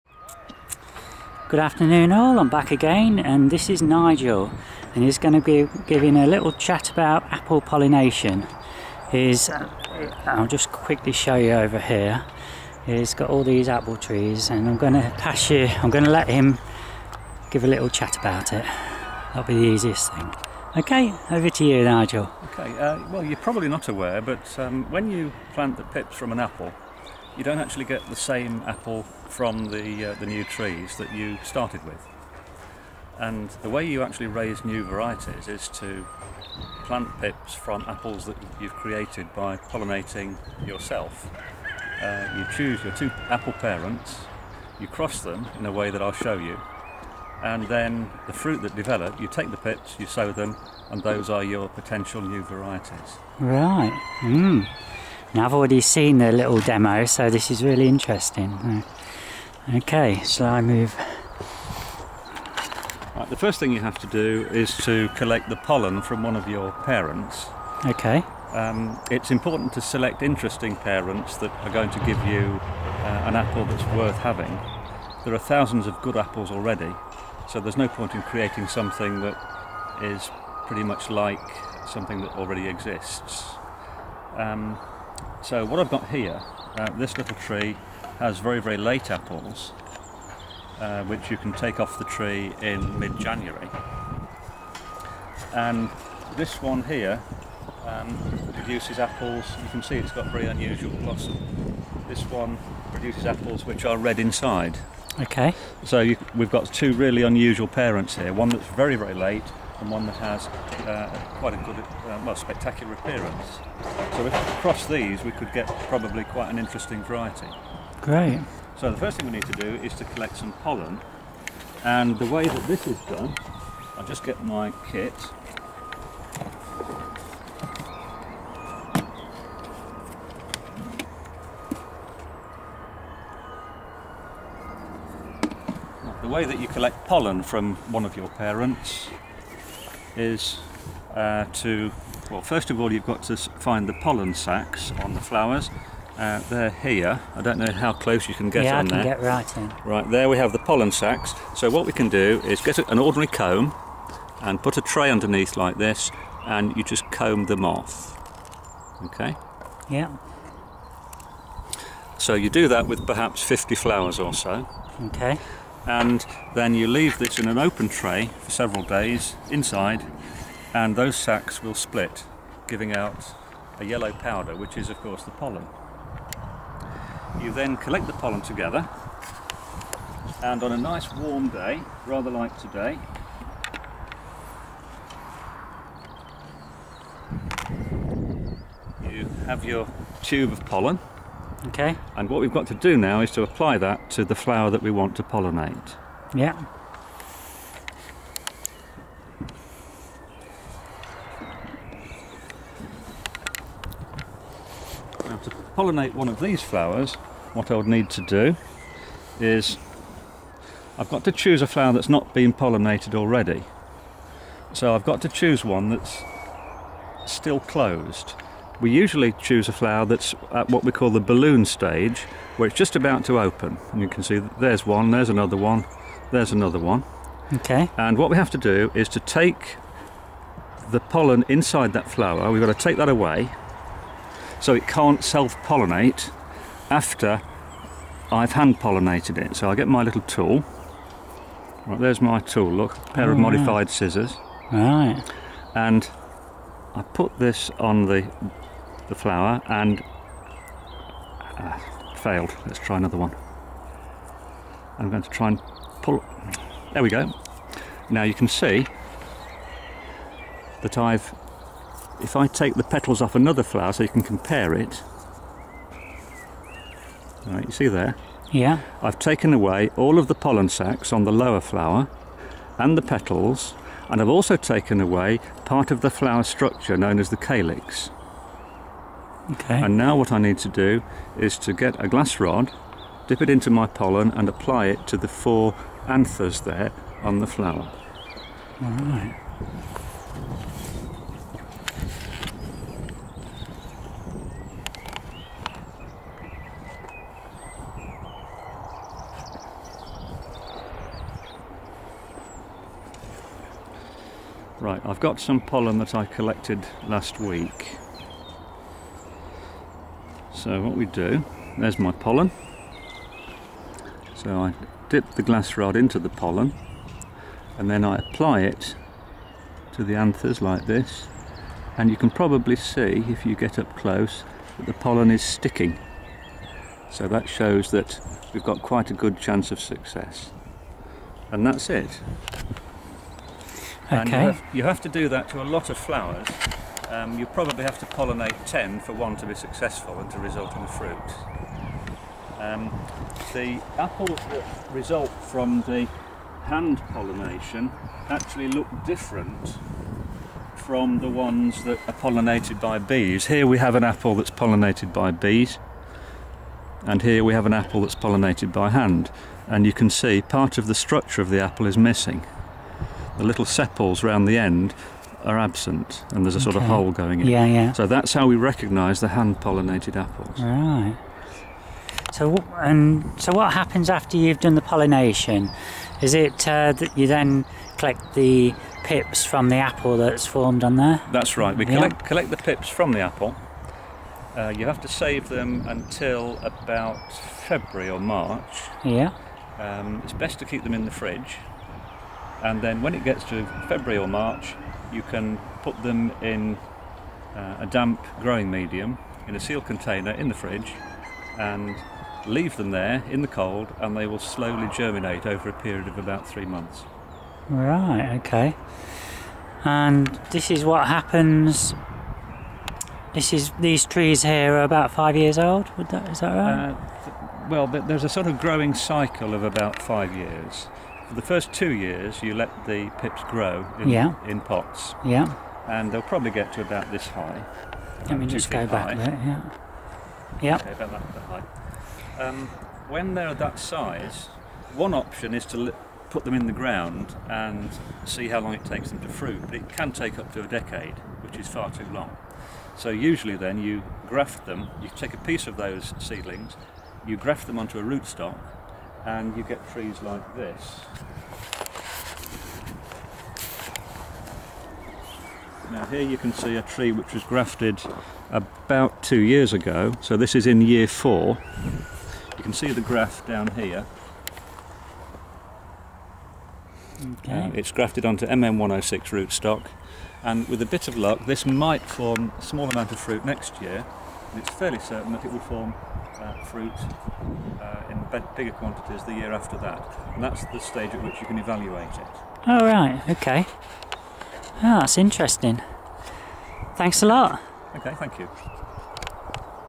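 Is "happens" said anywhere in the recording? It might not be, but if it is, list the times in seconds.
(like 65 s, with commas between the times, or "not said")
373 s, 411 s.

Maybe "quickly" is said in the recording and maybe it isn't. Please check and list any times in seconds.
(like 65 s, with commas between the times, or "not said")
10 s.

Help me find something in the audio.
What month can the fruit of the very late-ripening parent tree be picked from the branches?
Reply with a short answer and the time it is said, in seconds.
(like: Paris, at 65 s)
mid-January, at 92 s.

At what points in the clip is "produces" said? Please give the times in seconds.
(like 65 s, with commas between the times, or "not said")
98 s, 102 s.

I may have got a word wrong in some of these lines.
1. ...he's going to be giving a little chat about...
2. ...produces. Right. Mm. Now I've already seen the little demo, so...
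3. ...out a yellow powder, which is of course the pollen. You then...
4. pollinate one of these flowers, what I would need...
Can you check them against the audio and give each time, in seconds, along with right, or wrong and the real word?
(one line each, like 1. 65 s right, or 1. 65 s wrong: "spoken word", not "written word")
1. 5 s right
2. 52 s wrong: "varieties", not "produces"
3. 172 s right
4. 205 s right.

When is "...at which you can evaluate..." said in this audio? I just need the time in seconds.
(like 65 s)
481 s.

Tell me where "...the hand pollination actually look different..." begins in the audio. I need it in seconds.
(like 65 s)
345 s.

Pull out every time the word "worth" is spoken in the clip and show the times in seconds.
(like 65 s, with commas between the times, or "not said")
73 s.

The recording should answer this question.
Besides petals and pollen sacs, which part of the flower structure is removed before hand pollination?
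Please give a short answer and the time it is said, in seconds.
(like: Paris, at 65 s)
calyx, at 277 s.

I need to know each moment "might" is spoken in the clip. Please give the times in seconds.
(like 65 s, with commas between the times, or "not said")
471 s.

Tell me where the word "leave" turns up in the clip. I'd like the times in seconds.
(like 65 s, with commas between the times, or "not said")
166 s, 402 s.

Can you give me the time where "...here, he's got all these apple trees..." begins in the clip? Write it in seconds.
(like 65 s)
11 s.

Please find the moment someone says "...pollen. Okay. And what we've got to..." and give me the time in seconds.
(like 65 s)
190 s.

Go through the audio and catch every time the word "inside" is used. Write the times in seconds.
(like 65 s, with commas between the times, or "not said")
104 s, 169 s, 231 s.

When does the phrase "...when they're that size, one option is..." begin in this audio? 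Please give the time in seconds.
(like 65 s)
433 s.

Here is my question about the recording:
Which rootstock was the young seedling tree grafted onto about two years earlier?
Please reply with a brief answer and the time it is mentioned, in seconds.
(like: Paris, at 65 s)
MM106, at 468 s.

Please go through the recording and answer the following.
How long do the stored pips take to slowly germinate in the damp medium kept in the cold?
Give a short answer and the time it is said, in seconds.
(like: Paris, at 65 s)
about three months, at 406 s.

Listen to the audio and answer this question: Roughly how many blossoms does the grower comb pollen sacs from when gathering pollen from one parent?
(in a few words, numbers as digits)
50.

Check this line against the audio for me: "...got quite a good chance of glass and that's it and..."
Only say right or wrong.
wrong.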